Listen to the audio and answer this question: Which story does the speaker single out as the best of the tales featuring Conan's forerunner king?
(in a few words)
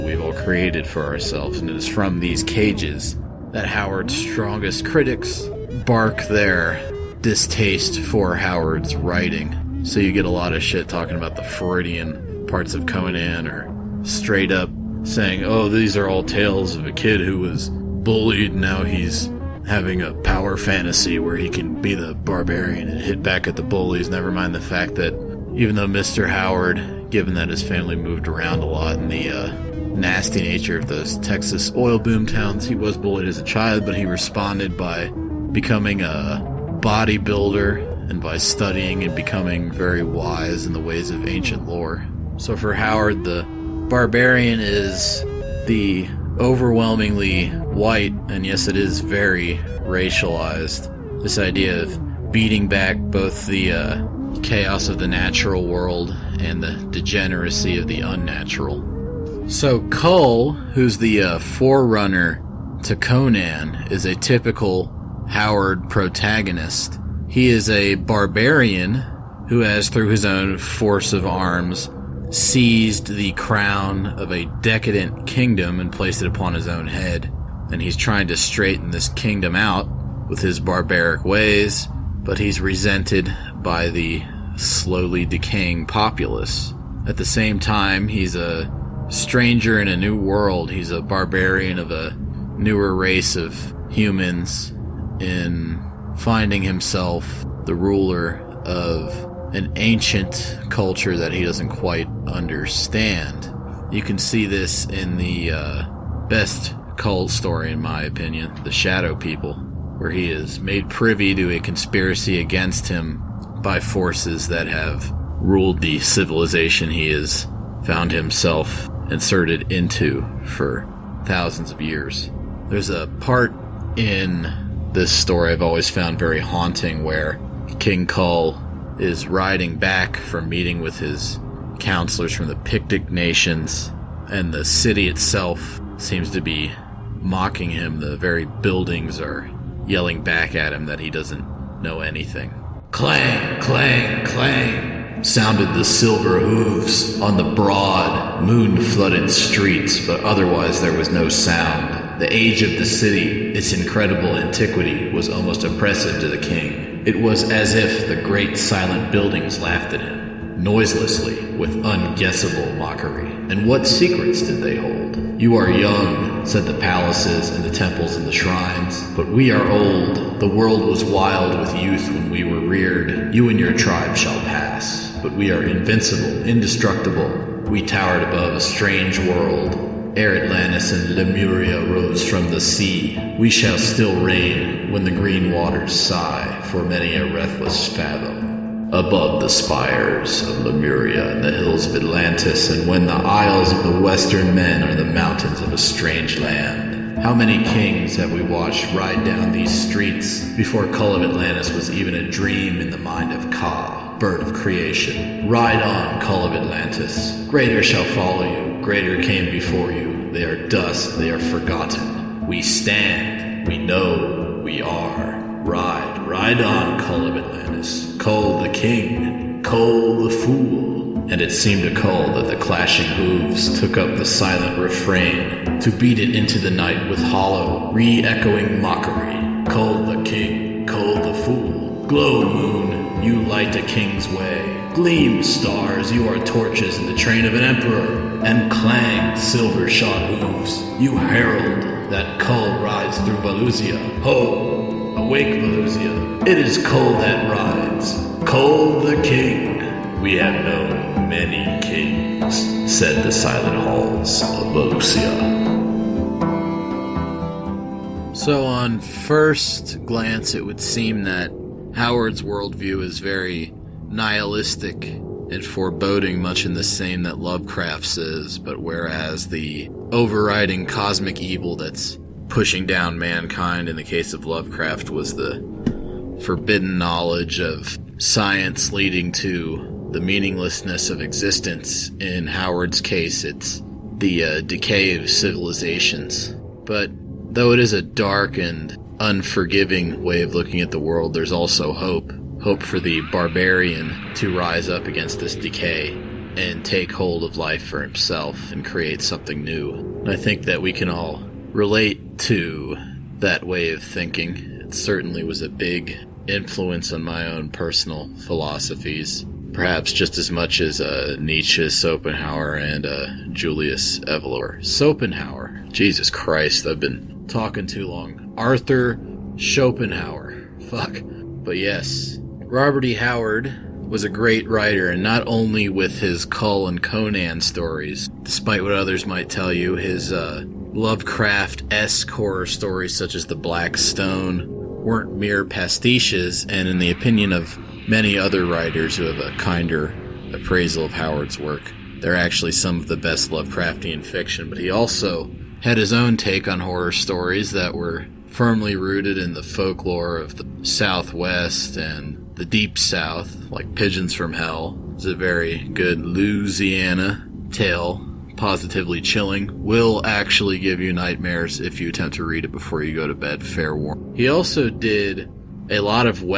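The Shadow People.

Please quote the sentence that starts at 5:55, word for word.
It's a very good Louisiana tale, positively chilling.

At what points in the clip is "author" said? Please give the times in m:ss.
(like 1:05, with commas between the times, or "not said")
not said.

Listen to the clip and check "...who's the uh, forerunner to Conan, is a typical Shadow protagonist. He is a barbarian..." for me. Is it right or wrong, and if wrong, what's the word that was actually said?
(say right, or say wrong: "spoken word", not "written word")
wrong: "Howard", not "Shadow".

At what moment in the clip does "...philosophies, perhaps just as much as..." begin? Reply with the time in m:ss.
5:08.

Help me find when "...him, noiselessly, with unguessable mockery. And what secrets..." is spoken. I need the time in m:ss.
2:40.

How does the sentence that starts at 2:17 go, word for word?
The very buildings are yelling back at him that he doesn't know anything.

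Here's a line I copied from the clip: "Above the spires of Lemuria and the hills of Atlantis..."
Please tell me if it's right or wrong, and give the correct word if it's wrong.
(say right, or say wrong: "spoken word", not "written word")
right.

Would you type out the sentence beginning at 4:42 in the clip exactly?
In Howard's case, it's the uh, decay of civilizations.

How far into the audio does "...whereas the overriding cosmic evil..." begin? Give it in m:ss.
4:28.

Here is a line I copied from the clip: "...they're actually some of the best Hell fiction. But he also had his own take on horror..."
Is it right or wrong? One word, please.
wrong.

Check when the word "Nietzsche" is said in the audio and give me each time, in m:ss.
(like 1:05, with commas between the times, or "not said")
5:11.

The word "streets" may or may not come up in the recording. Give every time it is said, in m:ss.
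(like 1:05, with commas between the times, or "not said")
2:29, 3:19.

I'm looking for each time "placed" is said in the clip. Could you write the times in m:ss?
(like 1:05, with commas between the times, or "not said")
1:15.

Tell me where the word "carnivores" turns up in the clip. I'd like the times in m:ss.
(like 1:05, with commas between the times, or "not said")
not said.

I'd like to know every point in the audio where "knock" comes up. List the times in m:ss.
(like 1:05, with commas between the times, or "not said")
not said.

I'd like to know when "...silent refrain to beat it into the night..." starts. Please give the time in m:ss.
3:44.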